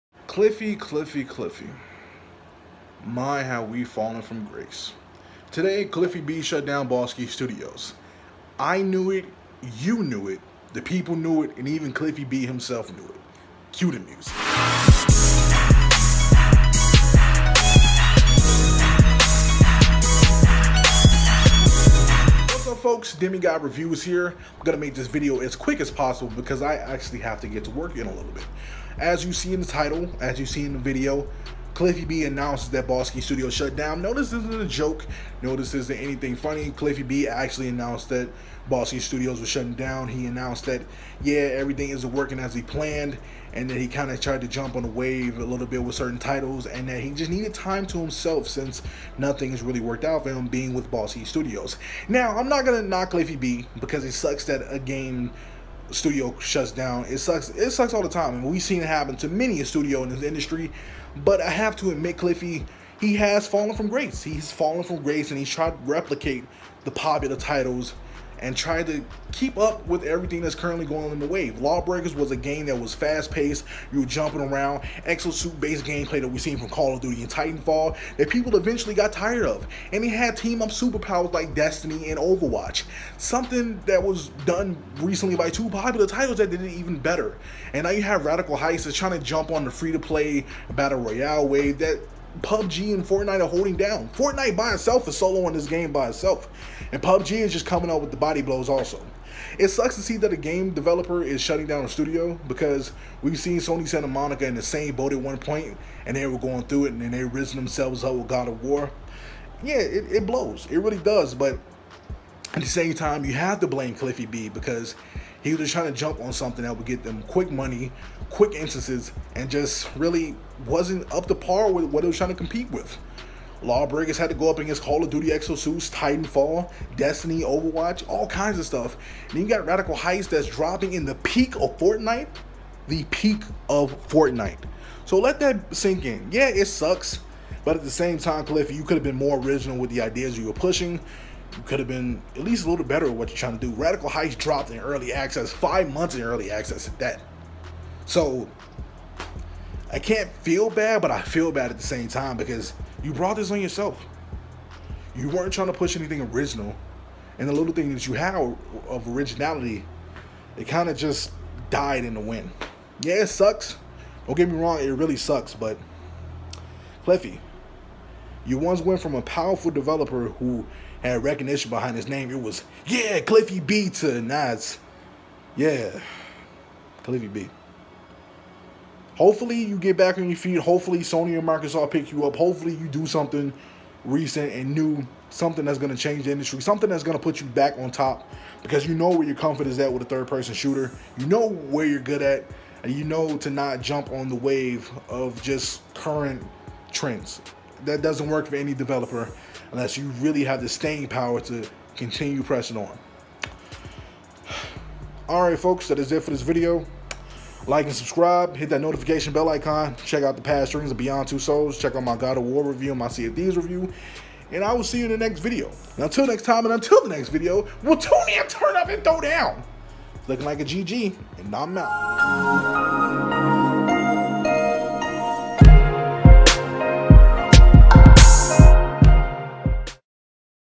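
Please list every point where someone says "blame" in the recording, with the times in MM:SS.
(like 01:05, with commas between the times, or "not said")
01:53.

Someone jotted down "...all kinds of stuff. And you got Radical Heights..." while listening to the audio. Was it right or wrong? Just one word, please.
right.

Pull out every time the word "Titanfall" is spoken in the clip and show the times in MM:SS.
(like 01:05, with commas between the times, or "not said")
01:17, 02:05.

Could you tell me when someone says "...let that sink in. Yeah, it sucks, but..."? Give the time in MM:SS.
02:15.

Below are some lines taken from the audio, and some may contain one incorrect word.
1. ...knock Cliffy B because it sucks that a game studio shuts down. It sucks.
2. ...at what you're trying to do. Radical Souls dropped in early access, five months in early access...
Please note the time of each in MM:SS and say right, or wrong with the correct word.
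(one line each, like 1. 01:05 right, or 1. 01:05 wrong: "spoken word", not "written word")
1. 00:52 right
2. 02:23 wrong: "Heights", not "Souls".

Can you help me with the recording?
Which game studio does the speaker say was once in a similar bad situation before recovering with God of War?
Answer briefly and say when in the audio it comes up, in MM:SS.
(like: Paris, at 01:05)
Sony Santa Monica, at 01:43.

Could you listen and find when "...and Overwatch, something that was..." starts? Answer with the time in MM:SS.
01:22.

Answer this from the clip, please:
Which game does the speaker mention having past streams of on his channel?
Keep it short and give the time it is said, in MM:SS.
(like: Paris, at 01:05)
Beyond Two Souls, at 03:30.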